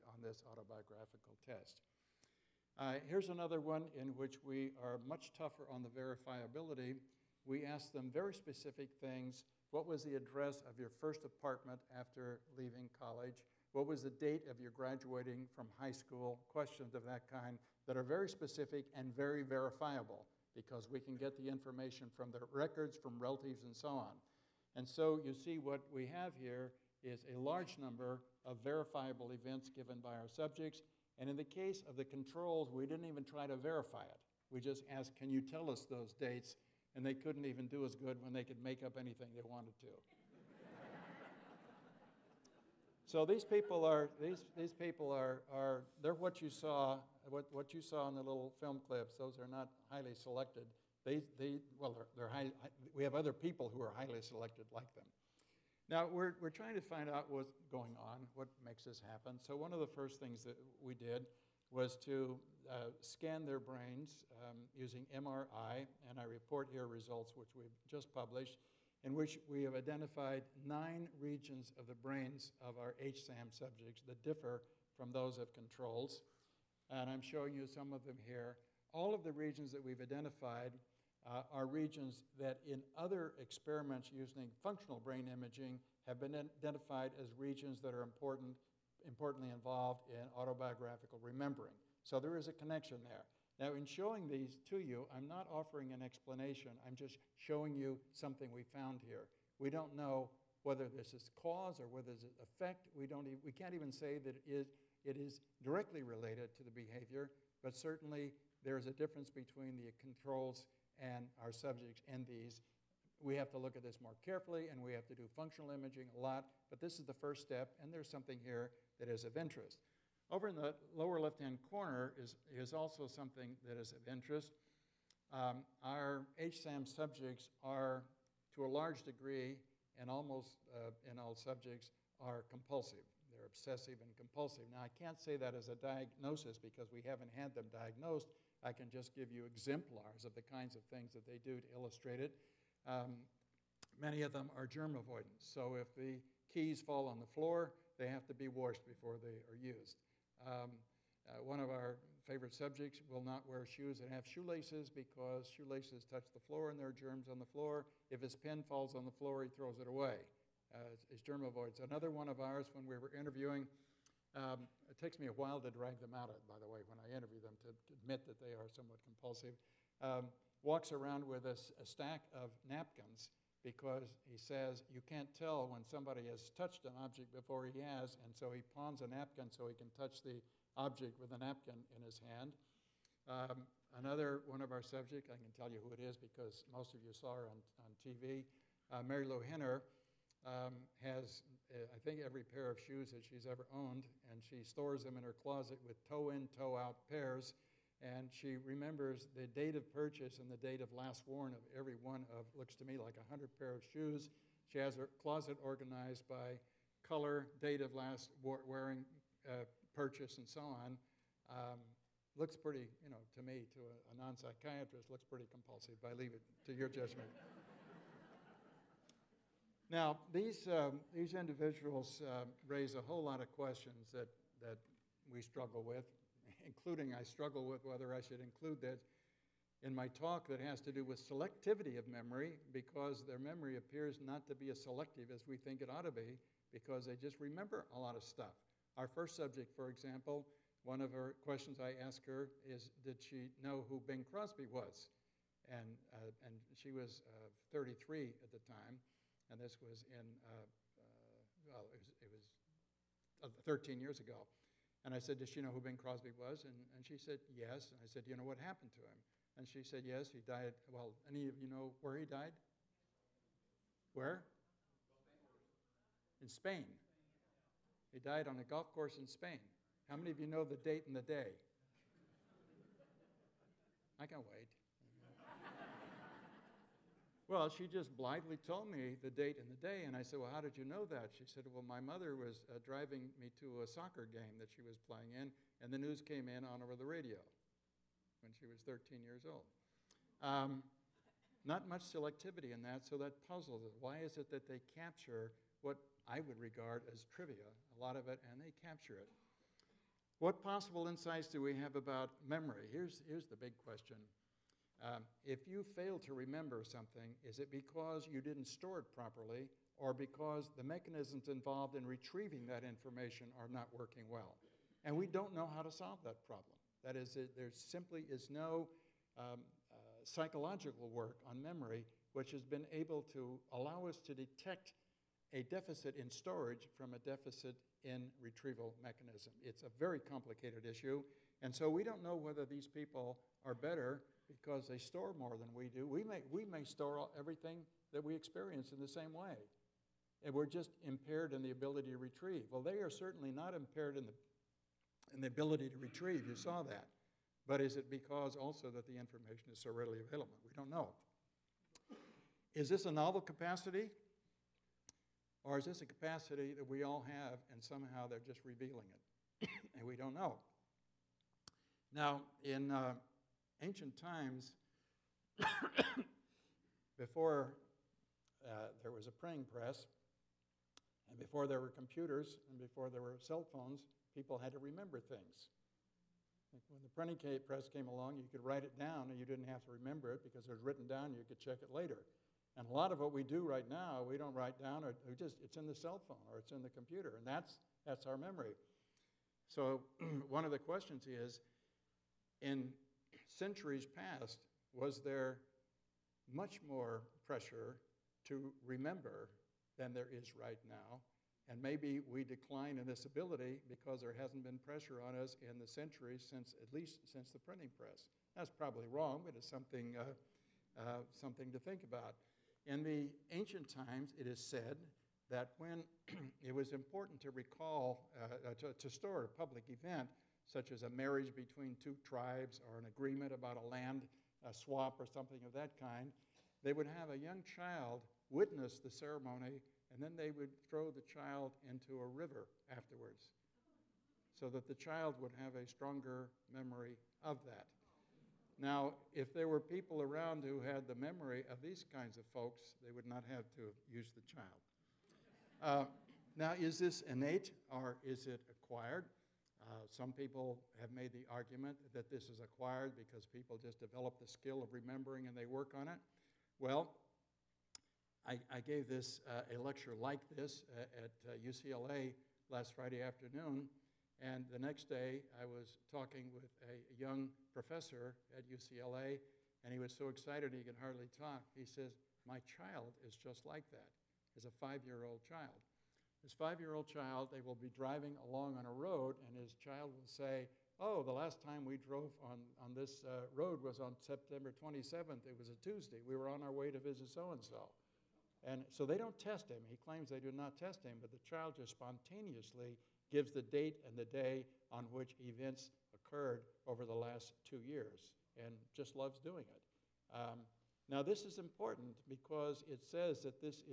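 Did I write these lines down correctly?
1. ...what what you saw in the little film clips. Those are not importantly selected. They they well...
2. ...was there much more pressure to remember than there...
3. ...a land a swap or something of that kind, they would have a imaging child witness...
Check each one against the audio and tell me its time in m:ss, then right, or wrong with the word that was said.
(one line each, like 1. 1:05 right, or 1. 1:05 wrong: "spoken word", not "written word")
1. 0:47 wrong: "highly", not "importantly"
2. 6:34 right
3. 7:03 wrong: "young", not "imaging".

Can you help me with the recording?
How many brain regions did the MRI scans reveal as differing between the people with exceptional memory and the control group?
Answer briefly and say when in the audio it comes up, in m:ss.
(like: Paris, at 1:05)
9, at 1:10.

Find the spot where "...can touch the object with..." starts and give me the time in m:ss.
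2:59.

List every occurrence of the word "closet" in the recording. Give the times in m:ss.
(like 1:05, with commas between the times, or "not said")
3:15, 3:25.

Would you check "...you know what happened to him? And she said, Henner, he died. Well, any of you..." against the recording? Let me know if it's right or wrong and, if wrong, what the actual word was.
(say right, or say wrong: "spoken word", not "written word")
wrong: "Yes", not "Henner".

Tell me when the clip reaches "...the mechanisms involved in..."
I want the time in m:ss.
5:10.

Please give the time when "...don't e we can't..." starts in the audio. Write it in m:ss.
1:43.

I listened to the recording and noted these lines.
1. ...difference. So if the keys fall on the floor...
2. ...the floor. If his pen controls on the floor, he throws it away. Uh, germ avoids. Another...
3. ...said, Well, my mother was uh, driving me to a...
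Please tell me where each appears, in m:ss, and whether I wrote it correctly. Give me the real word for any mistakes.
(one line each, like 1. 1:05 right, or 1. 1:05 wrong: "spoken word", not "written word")
1. 2:24 wrong: "avoidance", not "difference"
2. 2:37 wrong: "falls", not "controls"
3. 4:41 right.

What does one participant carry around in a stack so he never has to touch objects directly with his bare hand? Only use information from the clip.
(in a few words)
Napkins.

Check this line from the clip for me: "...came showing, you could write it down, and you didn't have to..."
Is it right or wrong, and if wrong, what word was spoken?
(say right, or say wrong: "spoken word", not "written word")
wrong: "along", not "showing".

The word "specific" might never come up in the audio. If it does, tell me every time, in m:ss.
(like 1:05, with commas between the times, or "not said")
0:08, 0:18.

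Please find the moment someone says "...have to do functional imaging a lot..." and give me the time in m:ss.
1:54.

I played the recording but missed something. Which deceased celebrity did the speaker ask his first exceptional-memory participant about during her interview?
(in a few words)
Bing Crosby.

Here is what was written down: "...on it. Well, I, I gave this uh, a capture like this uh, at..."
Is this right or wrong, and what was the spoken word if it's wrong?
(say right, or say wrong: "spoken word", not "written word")
wrong: "lecture", not "capture".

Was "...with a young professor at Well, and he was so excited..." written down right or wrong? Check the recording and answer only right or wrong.
wrong.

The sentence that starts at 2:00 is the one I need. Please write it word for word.
Over in the lower left-hand corner is, is also something that is of interest.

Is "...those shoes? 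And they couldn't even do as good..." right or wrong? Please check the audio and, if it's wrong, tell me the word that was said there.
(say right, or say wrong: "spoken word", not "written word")
wrong: "dates", not "shoes".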